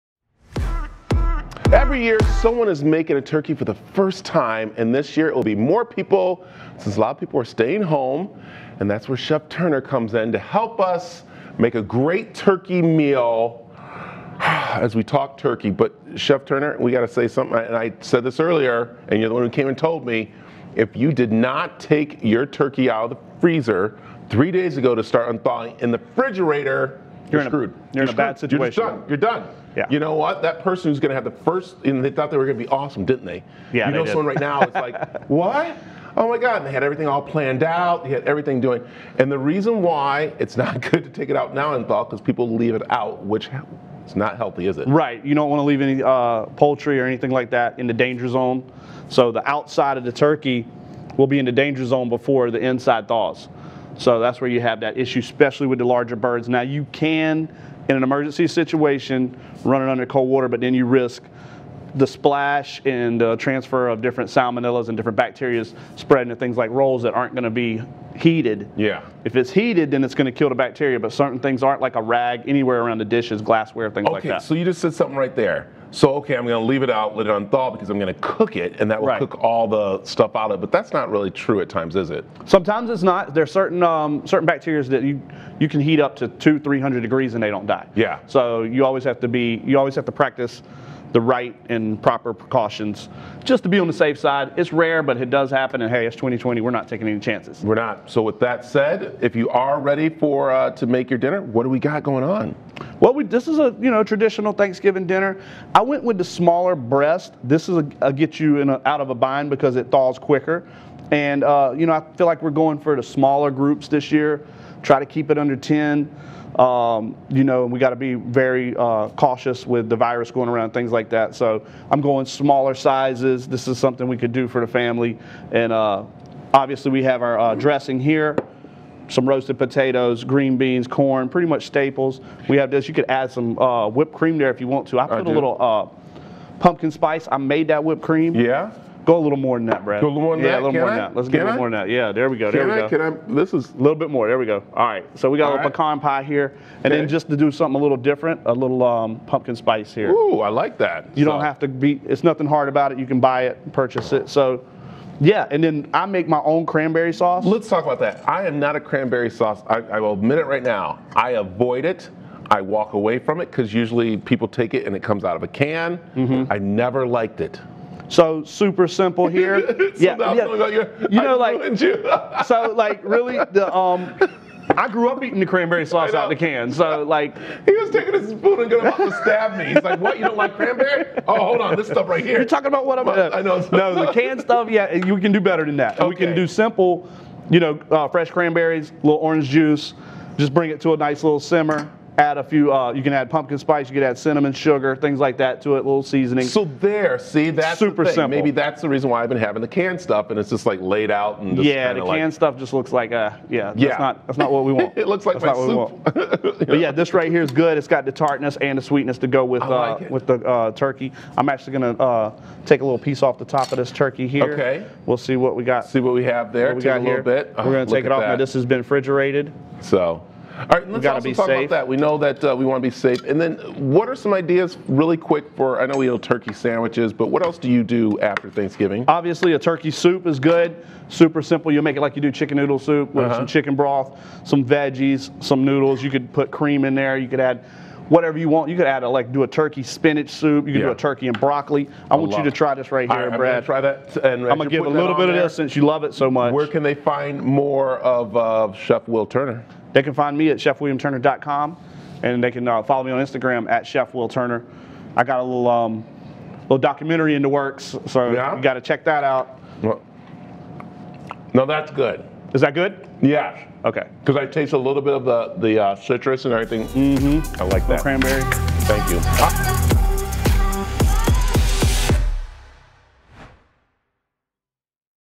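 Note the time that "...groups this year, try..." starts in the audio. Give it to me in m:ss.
1:53.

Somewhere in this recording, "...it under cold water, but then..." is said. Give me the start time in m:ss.
0:59.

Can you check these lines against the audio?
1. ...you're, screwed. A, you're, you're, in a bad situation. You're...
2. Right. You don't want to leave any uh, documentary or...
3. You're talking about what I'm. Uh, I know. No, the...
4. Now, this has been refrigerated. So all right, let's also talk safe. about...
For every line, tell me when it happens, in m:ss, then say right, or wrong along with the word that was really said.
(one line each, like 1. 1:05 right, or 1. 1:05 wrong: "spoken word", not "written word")
1. 0:27 right
2. 0:44 wrong: "poultry", not "documentary"
3. 3:02 right
4. 3:38 right.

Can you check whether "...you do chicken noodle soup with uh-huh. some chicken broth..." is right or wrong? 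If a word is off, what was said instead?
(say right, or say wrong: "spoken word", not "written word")
right.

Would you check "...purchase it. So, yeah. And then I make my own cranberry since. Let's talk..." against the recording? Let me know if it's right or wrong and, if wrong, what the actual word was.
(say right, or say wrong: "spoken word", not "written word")
wrong: "sauce", not "since".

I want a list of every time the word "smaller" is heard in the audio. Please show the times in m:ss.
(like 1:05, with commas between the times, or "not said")
1:46, 1:53, 2:02.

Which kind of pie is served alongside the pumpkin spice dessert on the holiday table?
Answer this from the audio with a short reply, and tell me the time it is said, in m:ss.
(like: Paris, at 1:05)
pecan pie, at 2:25.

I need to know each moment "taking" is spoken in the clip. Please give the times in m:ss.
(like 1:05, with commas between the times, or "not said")
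1:36, 2:57.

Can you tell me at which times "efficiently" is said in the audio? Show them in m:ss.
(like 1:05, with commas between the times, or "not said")
not said.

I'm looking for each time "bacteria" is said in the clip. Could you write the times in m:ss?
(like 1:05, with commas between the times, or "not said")
1:05, 1:10, 1:24.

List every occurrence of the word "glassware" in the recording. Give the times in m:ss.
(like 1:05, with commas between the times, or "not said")
1:13.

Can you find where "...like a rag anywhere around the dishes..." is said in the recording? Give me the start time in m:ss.
1:11.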